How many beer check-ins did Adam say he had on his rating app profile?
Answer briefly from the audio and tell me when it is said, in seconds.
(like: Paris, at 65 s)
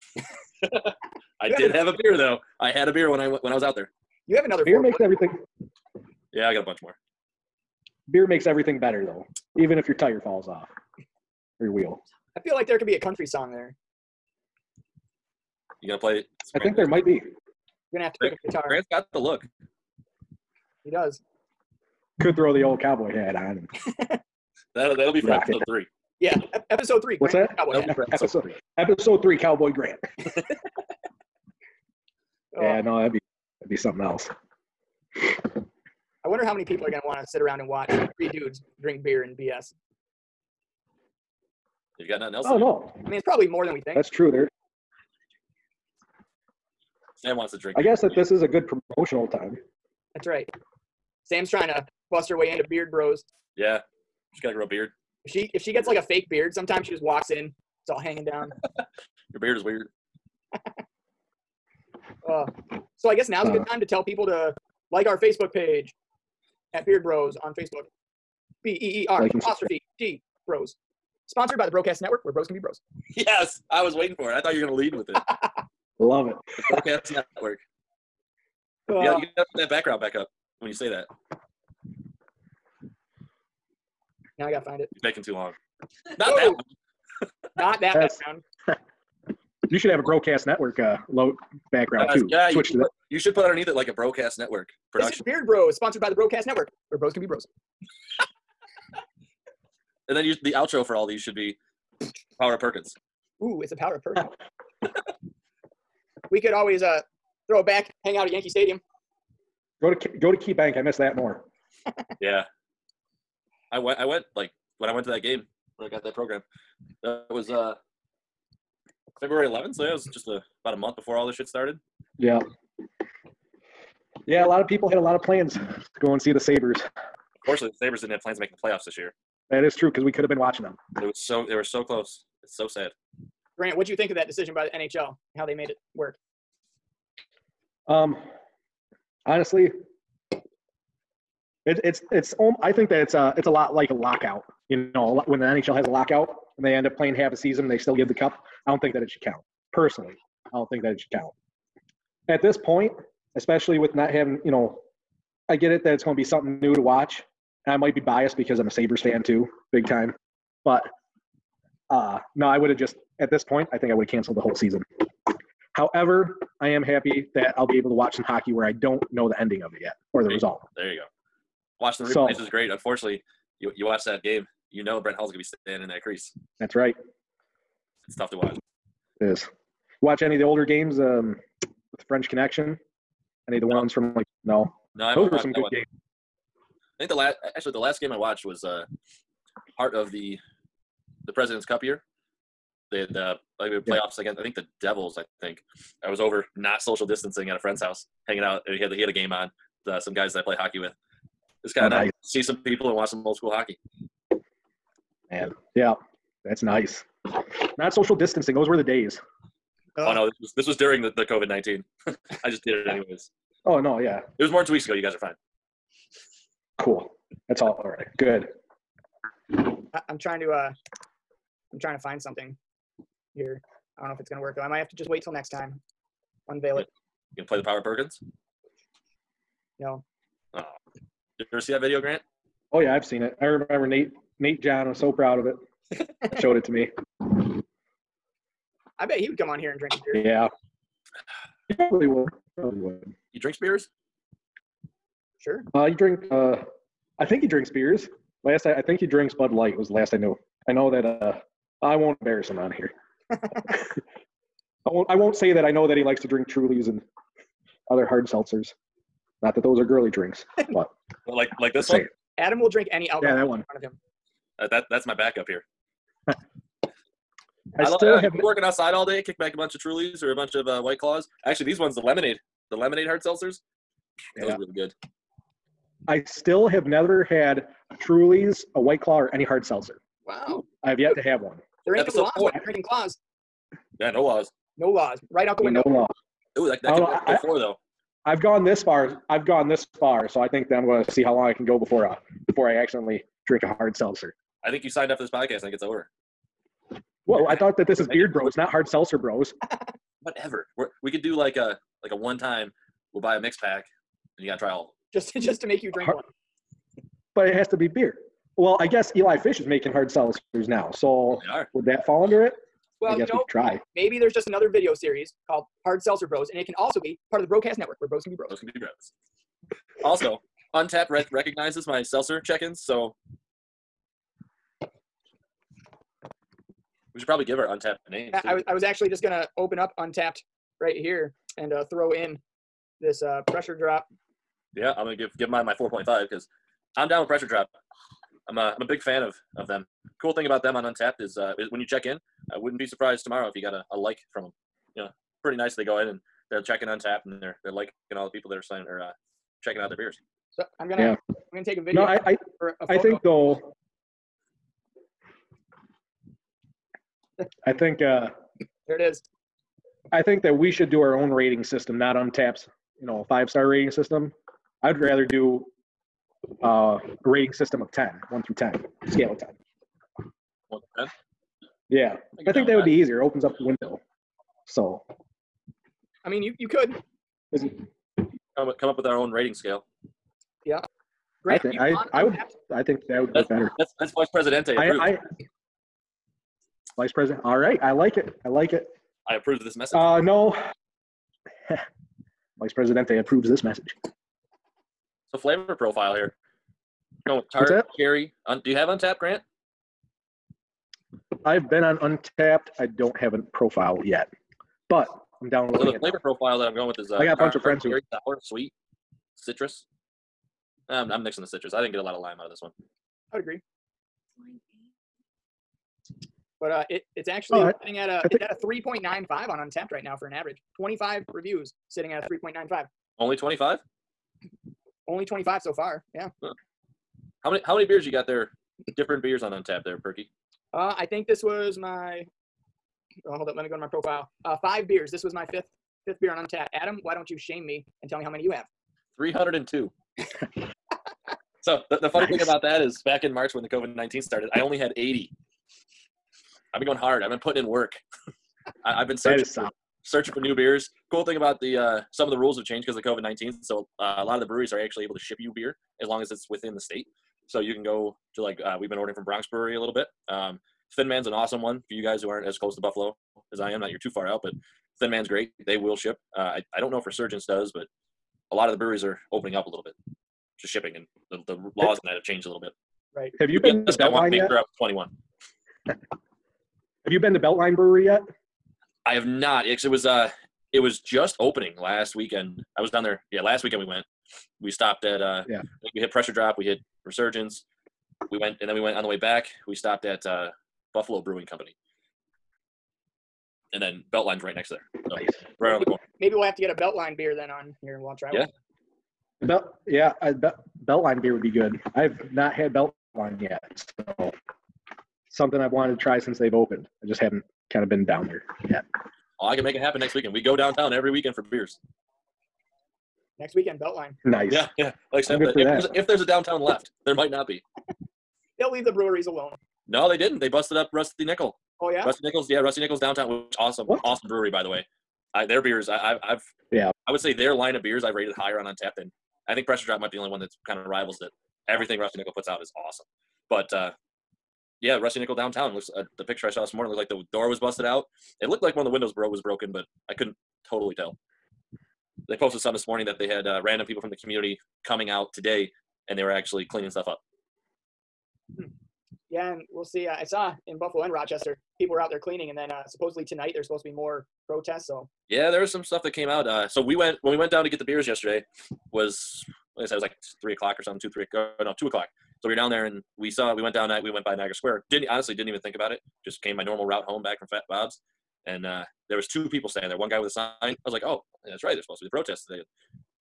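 302, at 439 s.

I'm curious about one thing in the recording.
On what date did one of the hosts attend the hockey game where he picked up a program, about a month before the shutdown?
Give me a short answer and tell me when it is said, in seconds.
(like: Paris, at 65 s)
February 11th, at 119 s.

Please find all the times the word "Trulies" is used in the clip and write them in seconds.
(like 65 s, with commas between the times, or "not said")
256 s, 269 s, 277 s.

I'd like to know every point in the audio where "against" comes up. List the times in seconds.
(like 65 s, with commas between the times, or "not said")
194 s.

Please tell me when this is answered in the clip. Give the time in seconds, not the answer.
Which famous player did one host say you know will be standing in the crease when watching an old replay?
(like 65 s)
175 s.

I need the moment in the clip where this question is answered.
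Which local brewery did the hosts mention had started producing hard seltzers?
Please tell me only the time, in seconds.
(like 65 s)
309 s.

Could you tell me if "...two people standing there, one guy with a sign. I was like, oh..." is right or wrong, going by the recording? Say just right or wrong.
right.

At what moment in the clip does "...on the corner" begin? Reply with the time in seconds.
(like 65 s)
495 s.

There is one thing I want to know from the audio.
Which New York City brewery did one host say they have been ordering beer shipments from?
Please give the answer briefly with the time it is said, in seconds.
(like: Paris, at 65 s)
Bronx Brewery, at 459 s.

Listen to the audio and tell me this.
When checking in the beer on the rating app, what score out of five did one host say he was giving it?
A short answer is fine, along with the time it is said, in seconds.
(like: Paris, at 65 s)
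4.5, at 335 s.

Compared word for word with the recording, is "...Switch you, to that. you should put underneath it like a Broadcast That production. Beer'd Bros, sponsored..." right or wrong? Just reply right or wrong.
wrong.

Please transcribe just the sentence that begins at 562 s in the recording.
So we were down there and we saw, we went down, we went by Niagara Square.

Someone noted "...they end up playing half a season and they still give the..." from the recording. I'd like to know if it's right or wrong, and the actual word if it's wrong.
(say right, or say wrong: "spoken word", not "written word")
right.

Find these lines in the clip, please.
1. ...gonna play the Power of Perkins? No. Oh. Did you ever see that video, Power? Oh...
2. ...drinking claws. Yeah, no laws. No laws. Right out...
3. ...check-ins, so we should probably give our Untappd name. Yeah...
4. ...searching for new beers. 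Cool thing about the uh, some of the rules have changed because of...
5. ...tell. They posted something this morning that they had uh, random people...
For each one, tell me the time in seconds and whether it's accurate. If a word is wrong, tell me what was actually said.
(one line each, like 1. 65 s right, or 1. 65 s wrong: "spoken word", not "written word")
1. 227 s wrong: "Grant", not "Power"
2. 282 s right
3. 322 s right
4. 450 s right
5. 540 s right.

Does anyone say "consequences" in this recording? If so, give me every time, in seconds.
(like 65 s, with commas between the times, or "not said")
not said.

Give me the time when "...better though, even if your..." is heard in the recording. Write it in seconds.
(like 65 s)
8 s.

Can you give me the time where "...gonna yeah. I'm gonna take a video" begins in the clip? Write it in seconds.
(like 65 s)
350 s.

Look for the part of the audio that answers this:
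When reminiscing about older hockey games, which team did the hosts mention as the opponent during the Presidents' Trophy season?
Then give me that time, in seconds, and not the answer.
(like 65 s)
194 s.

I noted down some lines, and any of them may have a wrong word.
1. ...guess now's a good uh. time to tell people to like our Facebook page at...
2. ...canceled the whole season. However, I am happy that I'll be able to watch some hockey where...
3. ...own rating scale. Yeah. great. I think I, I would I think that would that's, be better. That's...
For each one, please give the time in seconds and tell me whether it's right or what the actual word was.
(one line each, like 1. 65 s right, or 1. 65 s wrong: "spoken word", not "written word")
1. 63 s right
2. 164 s right
3. 379 s right.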